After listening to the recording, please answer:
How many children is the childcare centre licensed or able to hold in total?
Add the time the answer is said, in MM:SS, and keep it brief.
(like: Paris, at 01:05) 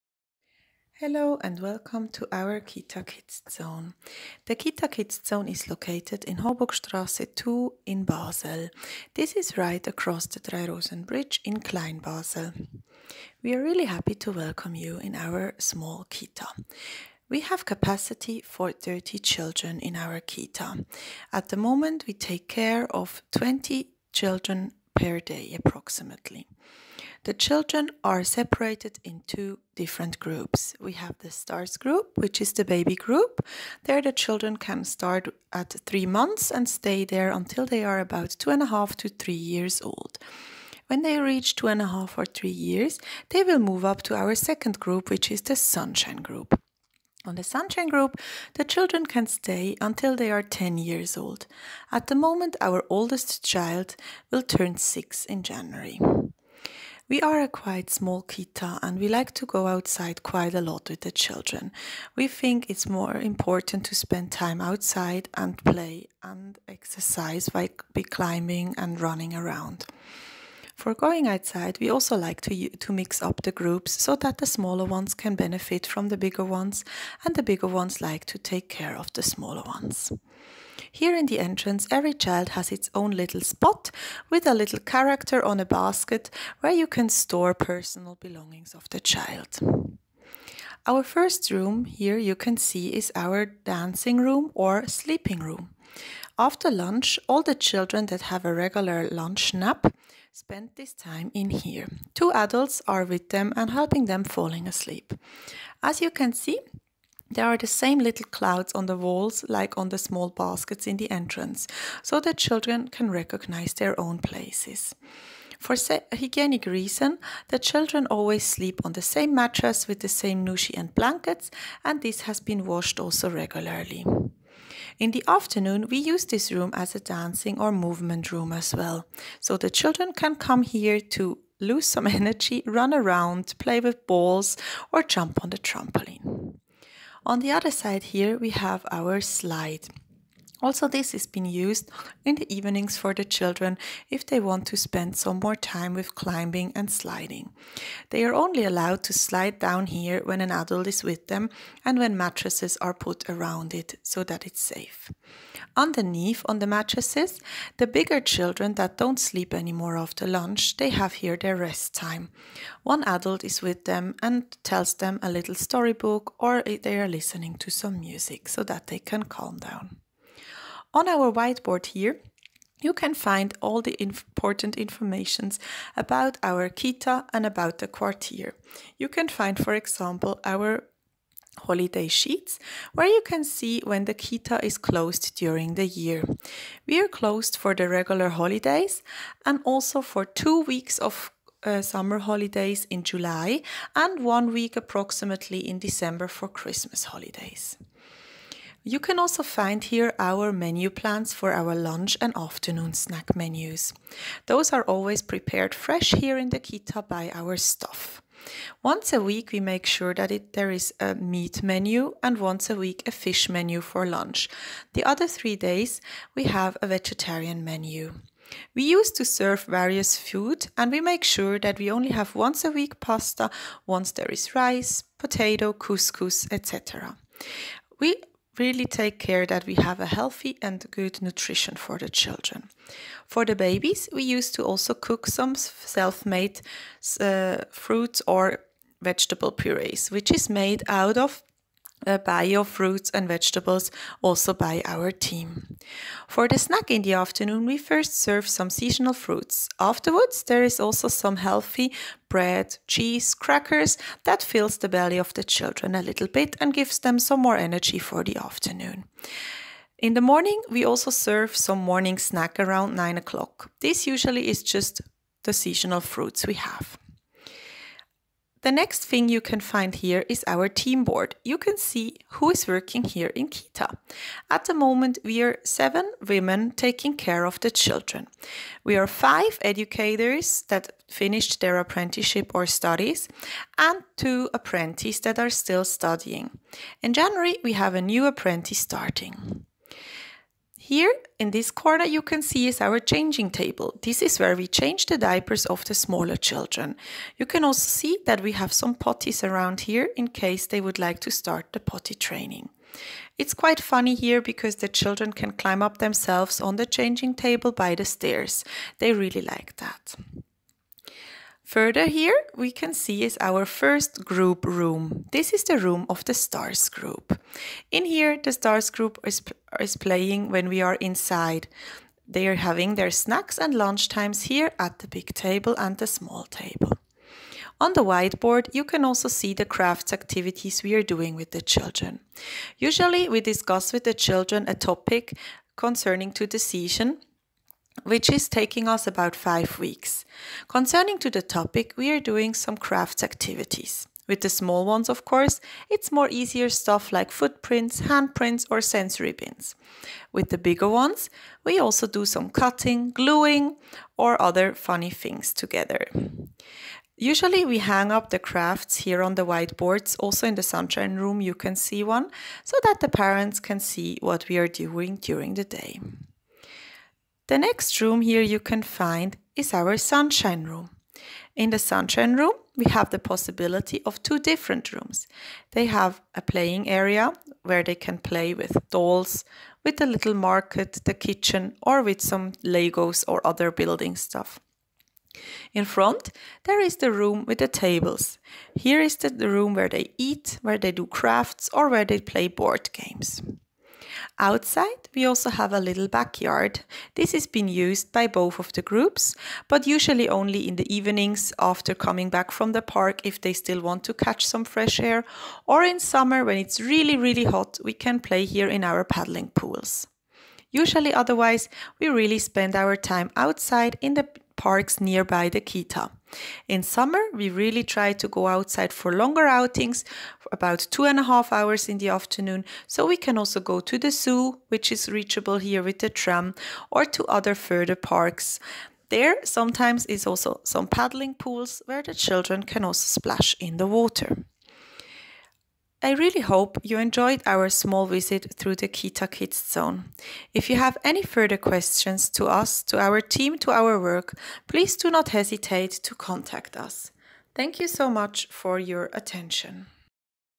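30, at 00:18.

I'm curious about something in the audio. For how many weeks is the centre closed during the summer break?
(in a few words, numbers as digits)
2.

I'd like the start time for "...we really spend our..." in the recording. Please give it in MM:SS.
06:51.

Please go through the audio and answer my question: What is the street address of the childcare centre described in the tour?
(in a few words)
Horburgstrasse 2.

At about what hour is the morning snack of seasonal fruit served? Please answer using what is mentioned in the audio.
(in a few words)
9 o'clock.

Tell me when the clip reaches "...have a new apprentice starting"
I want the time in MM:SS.
04:47.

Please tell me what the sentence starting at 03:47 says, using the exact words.
We really take care that we have a healthy and good nutrition for the children.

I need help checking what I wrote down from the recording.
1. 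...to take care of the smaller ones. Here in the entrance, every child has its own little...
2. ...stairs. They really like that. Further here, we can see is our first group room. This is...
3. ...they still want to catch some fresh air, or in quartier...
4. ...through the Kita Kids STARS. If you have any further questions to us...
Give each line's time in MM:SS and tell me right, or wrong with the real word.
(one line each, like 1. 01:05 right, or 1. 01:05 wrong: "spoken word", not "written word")
1. 01:18 right
2. 05:08 right
3. 06:43 wrong: "summer", not "quartier"
4. 07:18 wrong: "Zone", not "STARS".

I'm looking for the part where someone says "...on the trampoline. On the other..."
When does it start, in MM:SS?
02:15.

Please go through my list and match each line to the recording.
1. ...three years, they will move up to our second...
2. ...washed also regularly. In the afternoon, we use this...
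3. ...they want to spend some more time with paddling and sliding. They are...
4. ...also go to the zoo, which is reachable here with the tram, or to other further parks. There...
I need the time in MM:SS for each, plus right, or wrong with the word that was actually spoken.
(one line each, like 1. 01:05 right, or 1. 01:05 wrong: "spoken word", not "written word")
1. 00:42 right
2. 02:02 right
3. 02:24 wrong: "climbing", not "paddling"
4. 07:03 right.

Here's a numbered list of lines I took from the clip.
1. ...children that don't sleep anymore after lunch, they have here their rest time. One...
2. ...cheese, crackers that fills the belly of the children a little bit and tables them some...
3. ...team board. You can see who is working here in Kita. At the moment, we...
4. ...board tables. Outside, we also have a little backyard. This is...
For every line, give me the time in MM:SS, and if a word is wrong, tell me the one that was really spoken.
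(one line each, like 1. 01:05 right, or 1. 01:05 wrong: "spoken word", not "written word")
1. 02:38 right
2. 04:12 wrong: "gives", not "tables"
3. 04:30 right
4. 06:32 wrong: "games", not "tables".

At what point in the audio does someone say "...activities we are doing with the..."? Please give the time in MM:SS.
05:30.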